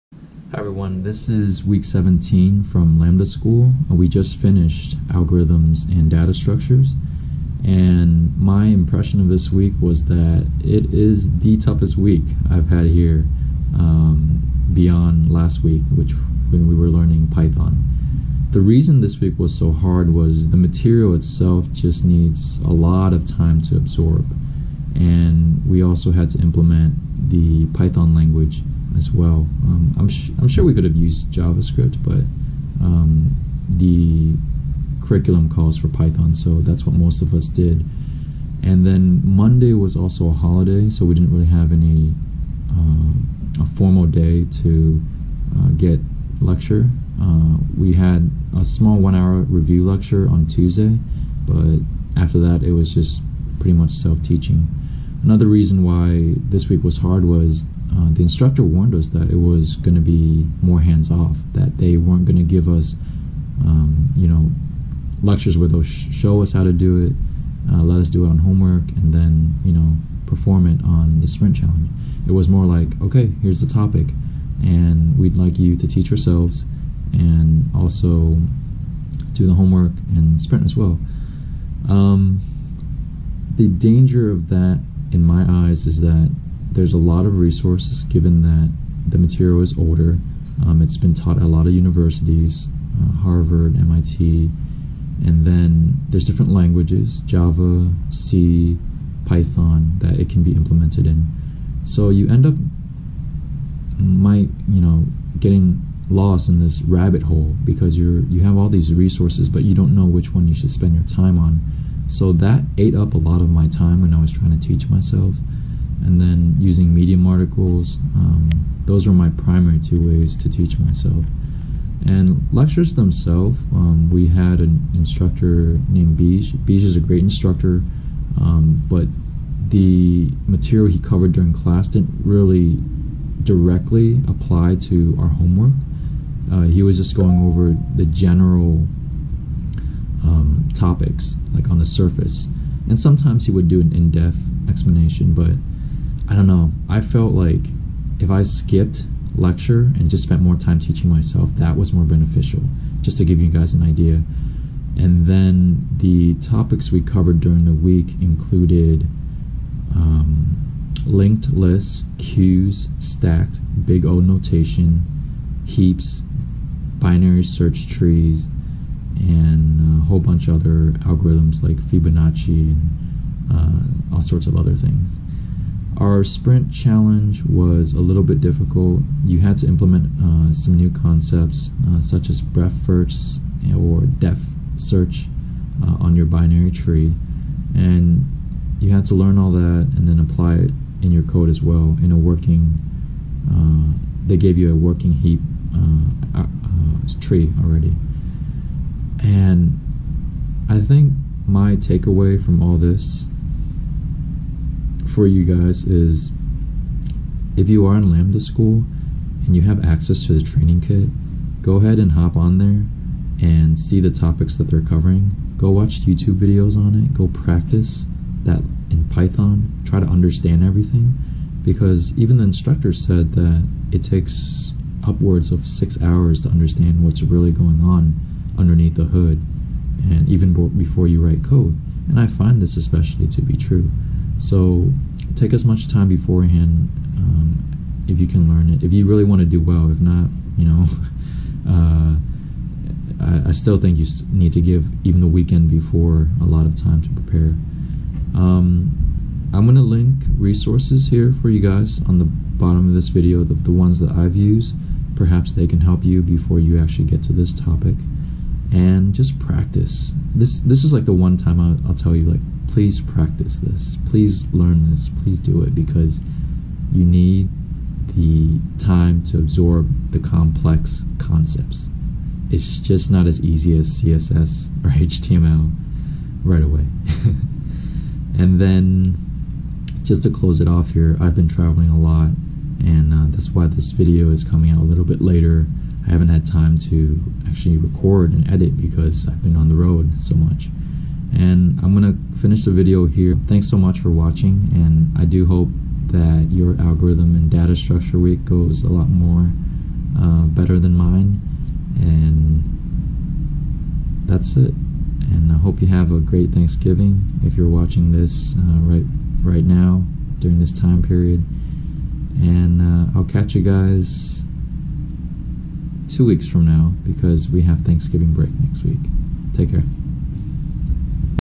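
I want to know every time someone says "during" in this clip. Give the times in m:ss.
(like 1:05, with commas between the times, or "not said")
2:11, 2:37, 5:10.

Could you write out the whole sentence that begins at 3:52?
And I find this especially to be true.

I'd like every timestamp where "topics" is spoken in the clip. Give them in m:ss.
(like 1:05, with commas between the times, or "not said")
1:13, 2:20, 2:36, 3:34, 4:17.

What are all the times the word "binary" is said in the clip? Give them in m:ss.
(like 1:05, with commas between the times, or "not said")
2:46, 3:06.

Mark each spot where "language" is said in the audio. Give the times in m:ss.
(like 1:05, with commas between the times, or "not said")
0:28, 1:36.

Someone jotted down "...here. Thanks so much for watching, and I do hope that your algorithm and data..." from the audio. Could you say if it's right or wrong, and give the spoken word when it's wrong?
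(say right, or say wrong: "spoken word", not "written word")
right.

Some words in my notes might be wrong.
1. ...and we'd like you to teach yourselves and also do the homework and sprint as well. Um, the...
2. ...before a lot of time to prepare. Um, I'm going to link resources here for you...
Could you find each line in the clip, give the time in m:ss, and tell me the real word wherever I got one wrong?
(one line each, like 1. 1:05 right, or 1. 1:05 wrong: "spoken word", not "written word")
1. 1:14 right
2. 4:05 right.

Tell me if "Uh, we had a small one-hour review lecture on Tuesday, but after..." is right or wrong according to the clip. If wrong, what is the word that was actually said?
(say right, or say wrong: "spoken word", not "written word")
right.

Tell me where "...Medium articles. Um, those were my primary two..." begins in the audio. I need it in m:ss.
1:56.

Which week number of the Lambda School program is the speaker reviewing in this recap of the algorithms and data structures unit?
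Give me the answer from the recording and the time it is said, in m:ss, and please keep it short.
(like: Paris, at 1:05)
17, at 0:01.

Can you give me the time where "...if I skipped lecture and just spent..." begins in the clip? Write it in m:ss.
2:28.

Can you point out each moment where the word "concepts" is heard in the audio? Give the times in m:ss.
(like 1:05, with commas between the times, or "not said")
3:00, 4:31.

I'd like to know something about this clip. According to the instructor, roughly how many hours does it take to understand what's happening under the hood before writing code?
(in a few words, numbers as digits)
6 hours.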